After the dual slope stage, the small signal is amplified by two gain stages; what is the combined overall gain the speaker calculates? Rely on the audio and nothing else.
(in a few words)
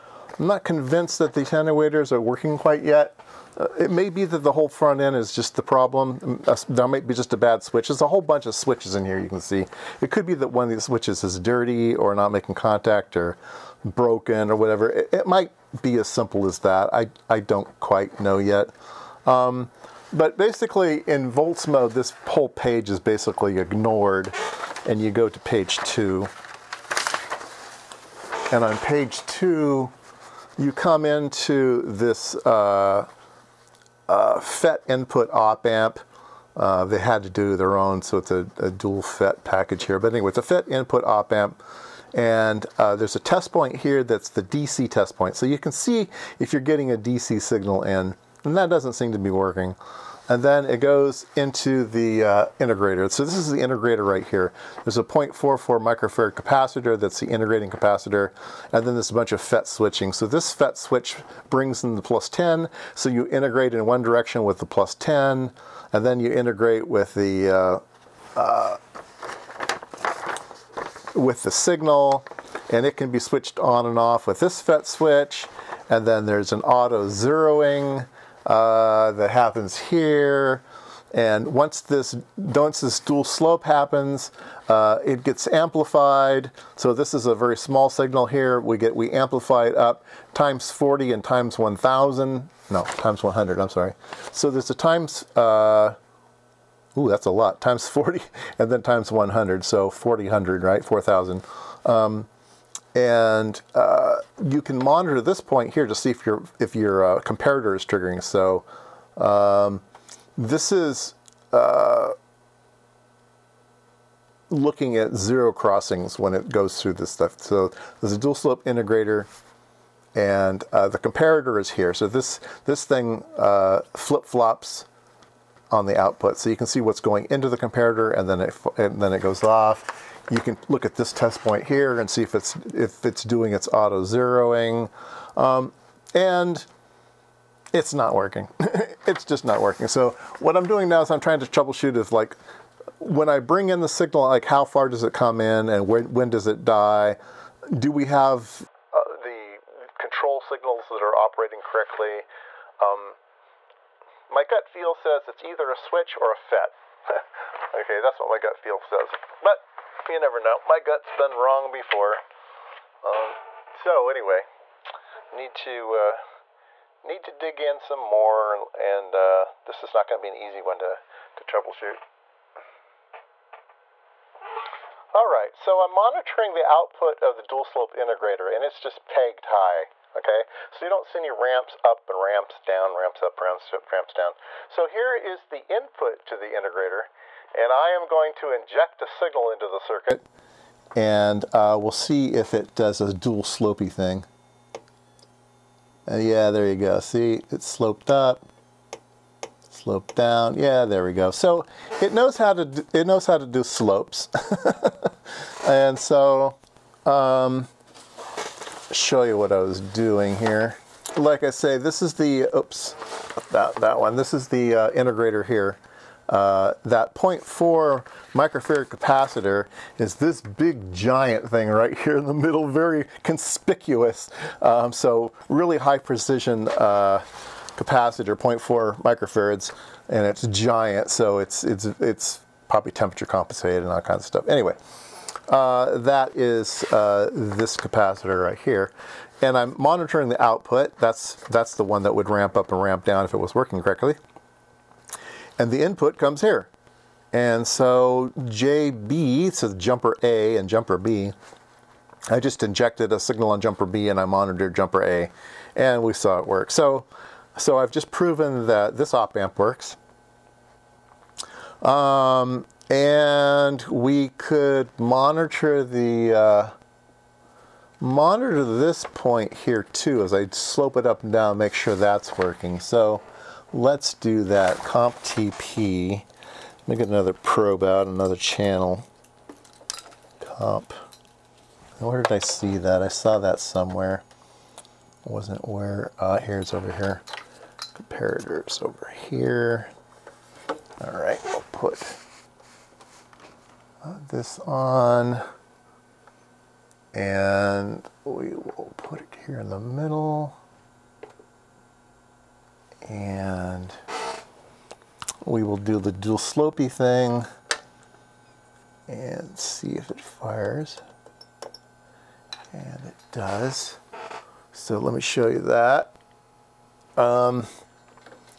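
4,000.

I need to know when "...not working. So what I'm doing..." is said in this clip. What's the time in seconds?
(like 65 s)
139 s.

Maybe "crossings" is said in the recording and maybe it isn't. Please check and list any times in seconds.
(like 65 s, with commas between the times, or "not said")
115 s.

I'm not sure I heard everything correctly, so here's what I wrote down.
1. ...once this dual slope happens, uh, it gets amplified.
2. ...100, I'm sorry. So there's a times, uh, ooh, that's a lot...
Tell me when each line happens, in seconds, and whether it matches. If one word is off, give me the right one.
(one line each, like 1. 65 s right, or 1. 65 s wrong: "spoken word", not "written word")
1. 82 s right
2. 93 s right.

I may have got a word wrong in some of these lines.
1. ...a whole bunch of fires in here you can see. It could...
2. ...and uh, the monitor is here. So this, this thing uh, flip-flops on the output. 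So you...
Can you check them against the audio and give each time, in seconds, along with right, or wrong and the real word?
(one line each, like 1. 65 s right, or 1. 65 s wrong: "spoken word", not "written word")
1. 8 s wrong: "switches", not "fires"
2. 120 s wrong: "comparator", not "monitor".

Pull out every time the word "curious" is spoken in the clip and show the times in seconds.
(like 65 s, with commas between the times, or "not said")
not said.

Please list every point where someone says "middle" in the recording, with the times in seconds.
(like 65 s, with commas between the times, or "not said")
222 s, 299 s.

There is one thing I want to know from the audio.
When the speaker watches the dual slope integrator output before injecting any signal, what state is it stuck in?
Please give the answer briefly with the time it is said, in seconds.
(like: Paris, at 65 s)
pegged high, at 179 s.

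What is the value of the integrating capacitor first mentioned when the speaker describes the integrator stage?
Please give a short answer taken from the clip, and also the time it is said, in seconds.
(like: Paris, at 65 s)
0.44 microfarad, at 55 s.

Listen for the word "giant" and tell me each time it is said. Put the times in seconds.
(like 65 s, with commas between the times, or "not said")
220 s, 230 s.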